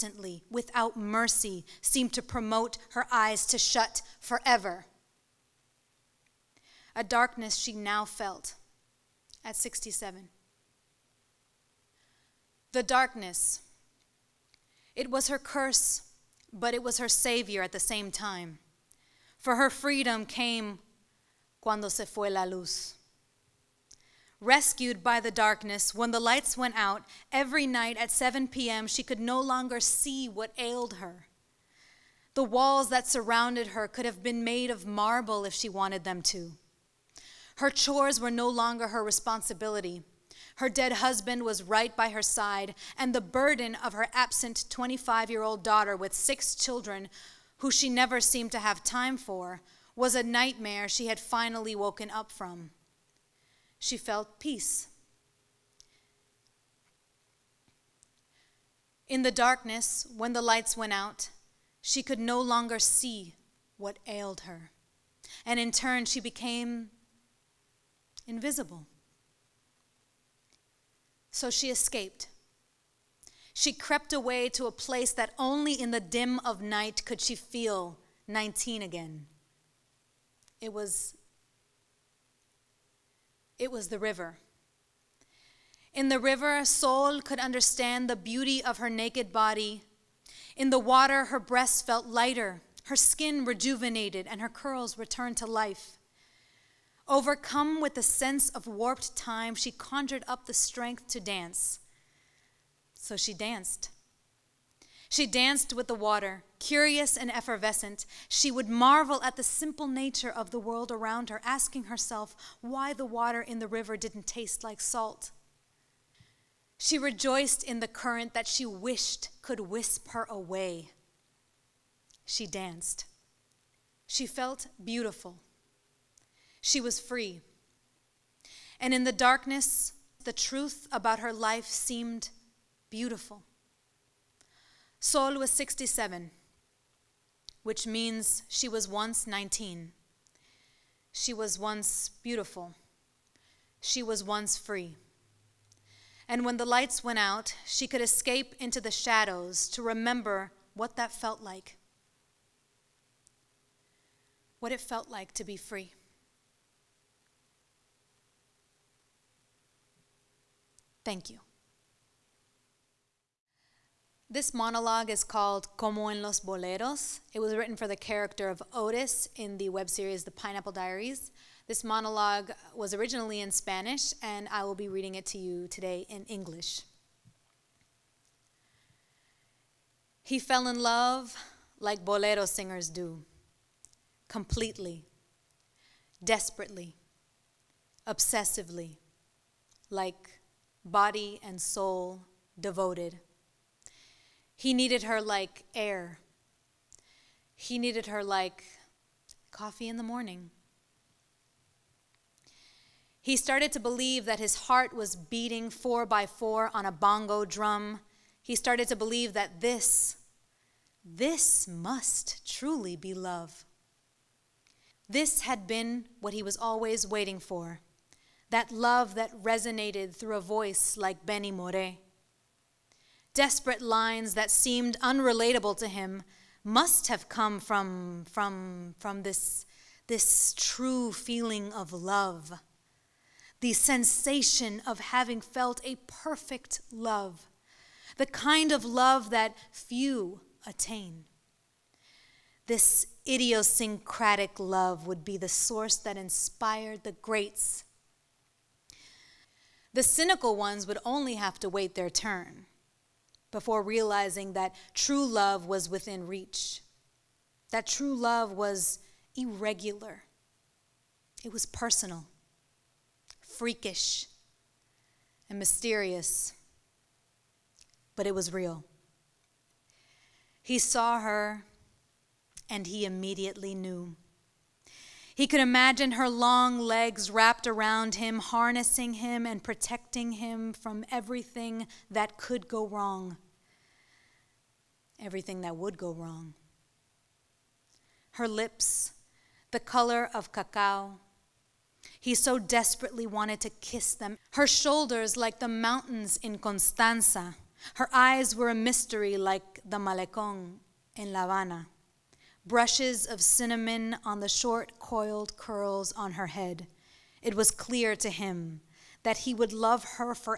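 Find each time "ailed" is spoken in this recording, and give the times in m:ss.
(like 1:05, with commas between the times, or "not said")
0:30, 1:04.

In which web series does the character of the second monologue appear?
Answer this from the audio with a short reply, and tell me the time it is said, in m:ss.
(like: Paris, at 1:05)
The Pineapple Diaries, at 2:50.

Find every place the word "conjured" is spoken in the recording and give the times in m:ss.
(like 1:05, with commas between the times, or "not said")
1:39.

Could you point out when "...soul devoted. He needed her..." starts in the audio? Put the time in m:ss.
3:11.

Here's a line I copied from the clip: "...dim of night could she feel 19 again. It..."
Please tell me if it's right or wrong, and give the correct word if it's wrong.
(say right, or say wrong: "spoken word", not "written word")
right.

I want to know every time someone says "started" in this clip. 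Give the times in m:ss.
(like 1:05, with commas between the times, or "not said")
3:23, 3:28.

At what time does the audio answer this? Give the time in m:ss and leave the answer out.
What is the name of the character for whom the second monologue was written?
2:48.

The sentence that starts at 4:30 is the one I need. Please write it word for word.
He saw her and he immediately knew.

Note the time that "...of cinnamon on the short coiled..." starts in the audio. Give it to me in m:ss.
5:03.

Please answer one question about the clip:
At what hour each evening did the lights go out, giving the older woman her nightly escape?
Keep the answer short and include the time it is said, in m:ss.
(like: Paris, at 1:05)
7 p.m., at 0:28.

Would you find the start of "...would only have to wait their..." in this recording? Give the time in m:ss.
4:10.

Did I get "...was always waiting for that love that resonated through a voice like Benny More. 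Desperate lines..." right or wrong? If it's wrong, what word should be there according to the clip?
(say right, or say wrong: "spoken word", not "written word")
right.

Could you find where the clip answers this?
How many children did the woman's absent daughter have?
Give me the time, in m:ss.
0:46.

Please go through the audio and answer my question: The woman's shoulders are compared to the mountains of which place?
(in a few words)
Constanza.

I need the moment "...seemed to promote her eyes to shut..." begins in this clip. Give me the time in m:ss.
0:01.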